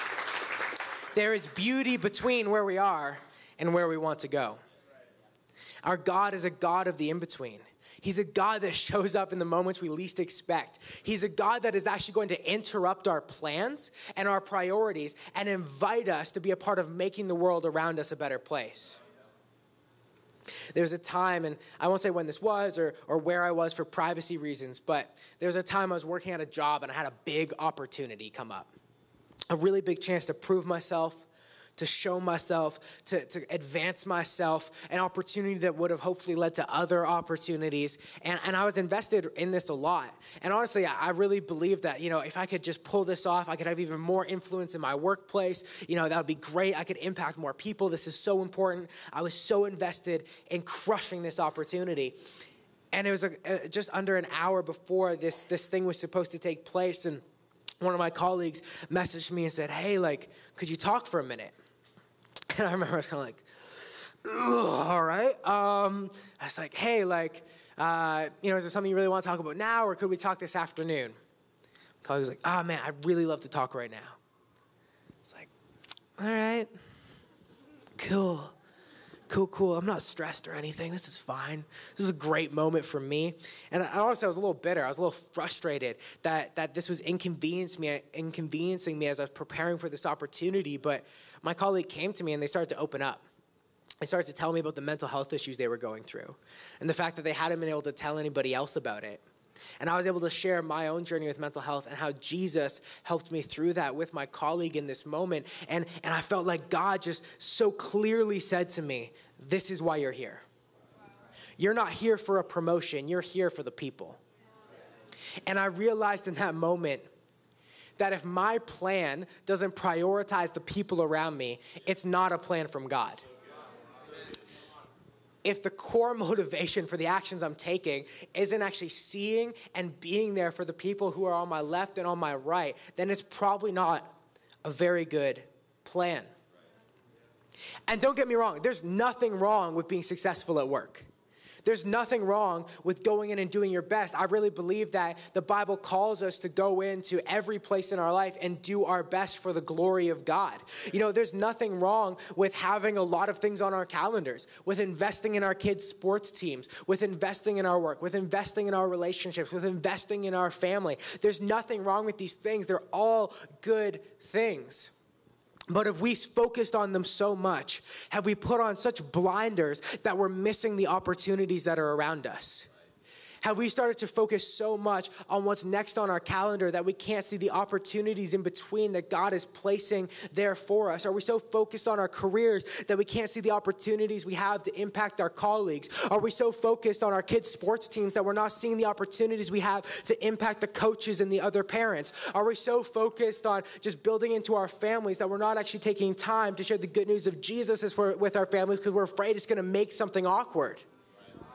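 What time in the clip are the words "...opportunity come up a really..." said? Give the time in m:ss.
0:27.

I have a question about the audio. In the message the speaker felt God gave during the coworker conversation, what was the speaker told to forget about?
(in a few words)
a promotion.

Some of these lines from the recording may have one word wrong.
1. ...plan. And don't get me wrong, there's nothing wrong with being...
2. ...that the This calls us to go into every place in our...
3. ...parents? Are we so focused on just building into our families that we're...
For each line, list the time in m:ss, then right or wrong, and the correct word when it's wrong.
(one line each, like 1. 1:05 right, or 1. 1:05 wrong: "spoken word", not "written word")
1. 2:15 right
2. 2:24 wrong: "Bible", not "This"
3. 3:11 right.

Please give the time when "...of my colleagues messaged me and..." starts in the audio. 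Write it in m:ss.
0:57.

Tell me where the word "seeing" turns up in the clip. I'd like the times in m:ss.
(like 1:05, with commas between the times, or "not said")
2:08, 3:08.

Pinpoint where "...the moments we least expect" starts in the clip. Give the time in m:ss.
0:09.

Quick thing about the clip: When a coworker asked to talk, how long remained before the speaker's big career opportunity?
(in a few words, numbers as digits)
just under an hour.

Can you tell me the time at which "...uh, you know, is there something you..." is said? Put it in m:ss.
1:07.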